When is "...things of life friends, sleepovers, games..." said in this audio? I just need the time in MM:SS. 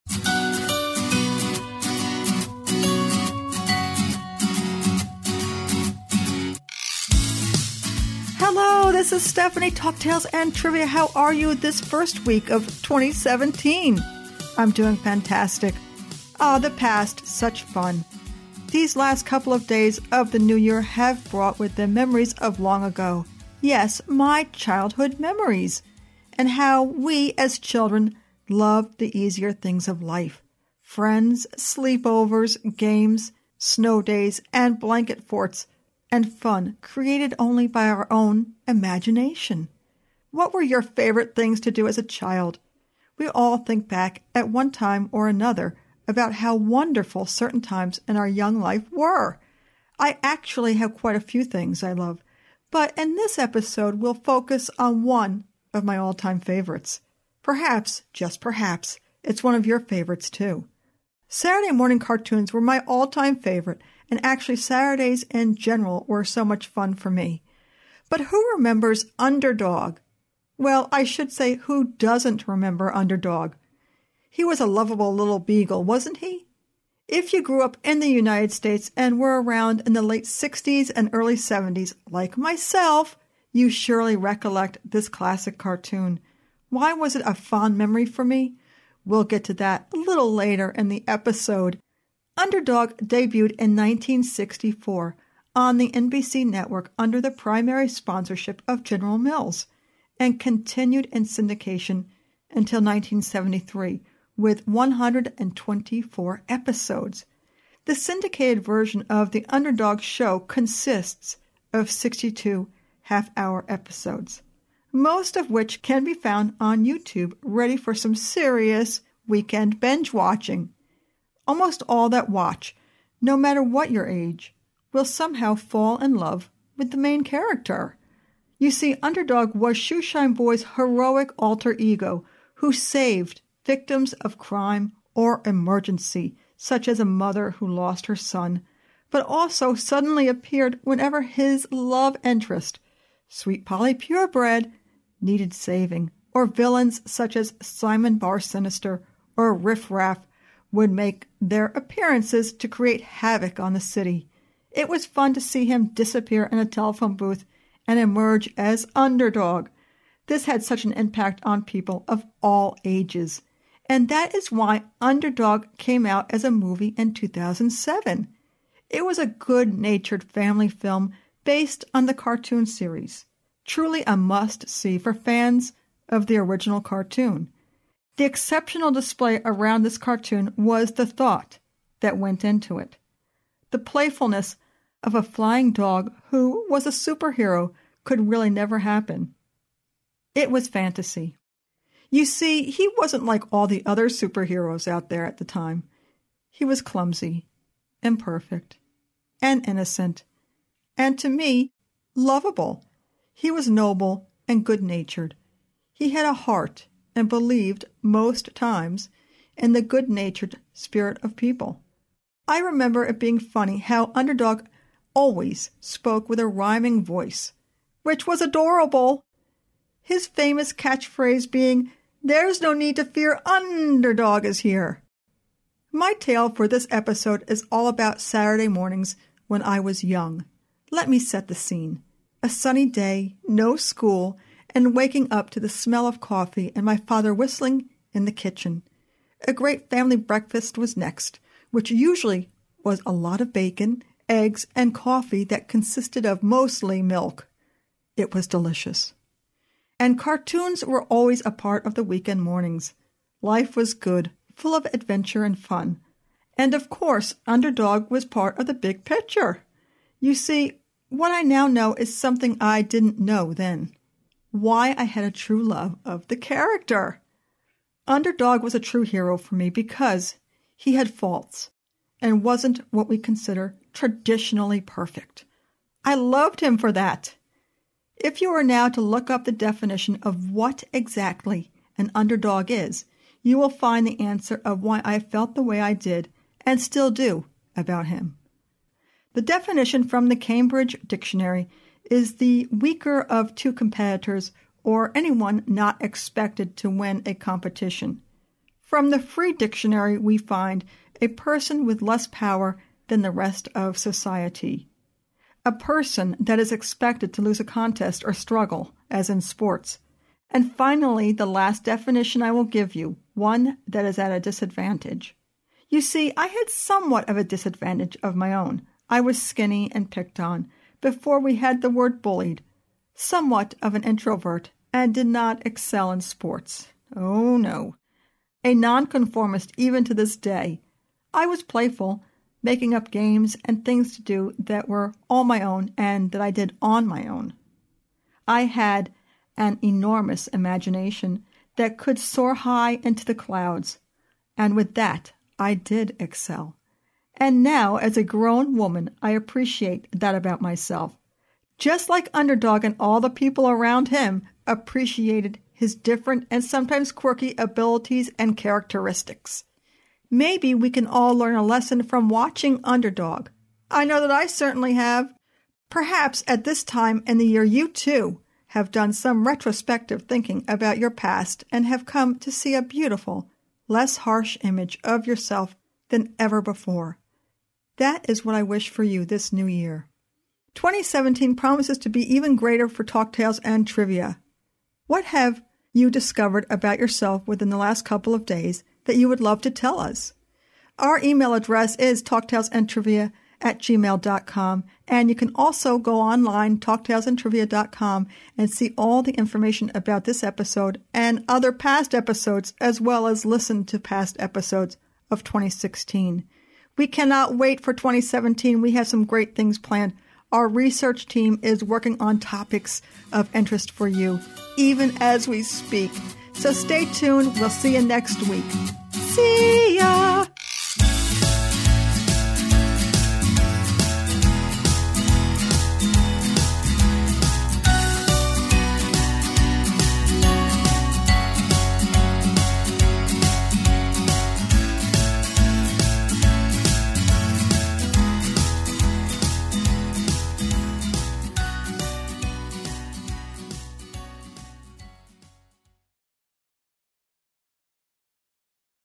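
00:29.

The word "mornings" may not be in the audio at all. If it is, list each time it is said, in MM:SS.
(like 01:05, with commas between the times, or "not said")
01:01, 03:48, 04:12.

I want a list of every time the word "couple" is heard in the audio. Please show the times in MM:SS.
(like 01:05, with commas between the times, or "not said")
00:19, 06:28.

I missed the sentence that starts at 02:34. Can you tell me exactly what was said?
It was fun to see him disappear in a telephone booth and emerge as underdog.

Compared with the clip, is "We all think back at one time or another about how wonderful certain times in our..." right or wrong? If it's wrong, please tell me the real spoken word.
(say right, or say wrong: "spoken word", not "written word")
right.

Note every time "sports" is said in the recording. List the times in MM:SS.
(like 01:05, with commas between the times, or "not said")
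05:09, 05:26.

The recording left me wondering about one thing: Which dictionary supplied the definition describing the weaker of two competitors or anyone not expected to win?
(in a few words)
Cambridge Dictionary.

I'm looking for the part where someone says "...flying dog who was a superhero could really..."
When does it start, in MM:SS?
03:05.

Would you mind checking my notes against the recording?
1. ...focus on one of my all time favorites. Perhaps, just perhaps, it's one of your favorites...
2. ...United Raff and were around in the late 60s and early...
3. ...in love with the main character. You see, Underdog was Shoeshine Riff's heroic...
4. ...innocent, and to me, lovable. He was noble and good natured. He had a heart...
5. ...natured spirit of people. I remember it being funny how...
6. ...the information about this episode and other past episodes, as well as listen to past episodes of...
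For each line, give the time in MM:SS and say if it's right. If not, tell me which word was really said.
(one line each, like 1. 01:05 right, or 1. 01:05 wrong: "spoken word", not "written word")
1. 00:54 right
2. 01:18 wrong: "States", not "Raff"
3. 02:05 wrong: "Boy", not "Riff"
4. 03:19 right
5. 03:30 right
6. 06:39 right.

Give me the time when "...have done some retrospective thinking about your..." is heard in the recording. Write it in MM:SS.
06:08.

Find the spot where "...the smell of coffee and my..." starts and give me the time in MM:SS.
03:55.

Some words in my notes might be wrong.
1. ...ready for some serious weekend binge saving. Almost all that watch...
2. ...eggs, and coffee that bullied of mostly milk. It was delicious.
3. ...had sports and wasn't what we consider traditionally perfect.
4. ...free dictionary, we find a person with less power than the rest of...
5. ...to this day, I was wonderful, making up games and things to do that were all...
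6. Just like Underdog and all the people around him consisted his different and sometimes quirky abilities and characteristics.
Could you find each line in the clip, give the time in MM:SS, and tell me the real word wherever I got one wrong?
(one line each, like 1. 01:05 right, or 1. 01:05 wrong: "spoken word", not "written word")
1. 01:57 wrong: "watching", not "saving"
2. 04:04 wrong: "consisted", not "bullied"
3. 04:30 wrong: "faults", not "sports"
4. 04:59 right
5. 05:30 wrong: "playful", not "wonderful"
6. 05:51 wrong: "appreciated", not "consisted".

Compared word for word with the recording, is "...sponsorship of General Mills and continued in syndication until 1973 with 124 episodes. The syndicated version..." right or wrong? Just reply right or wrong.
right.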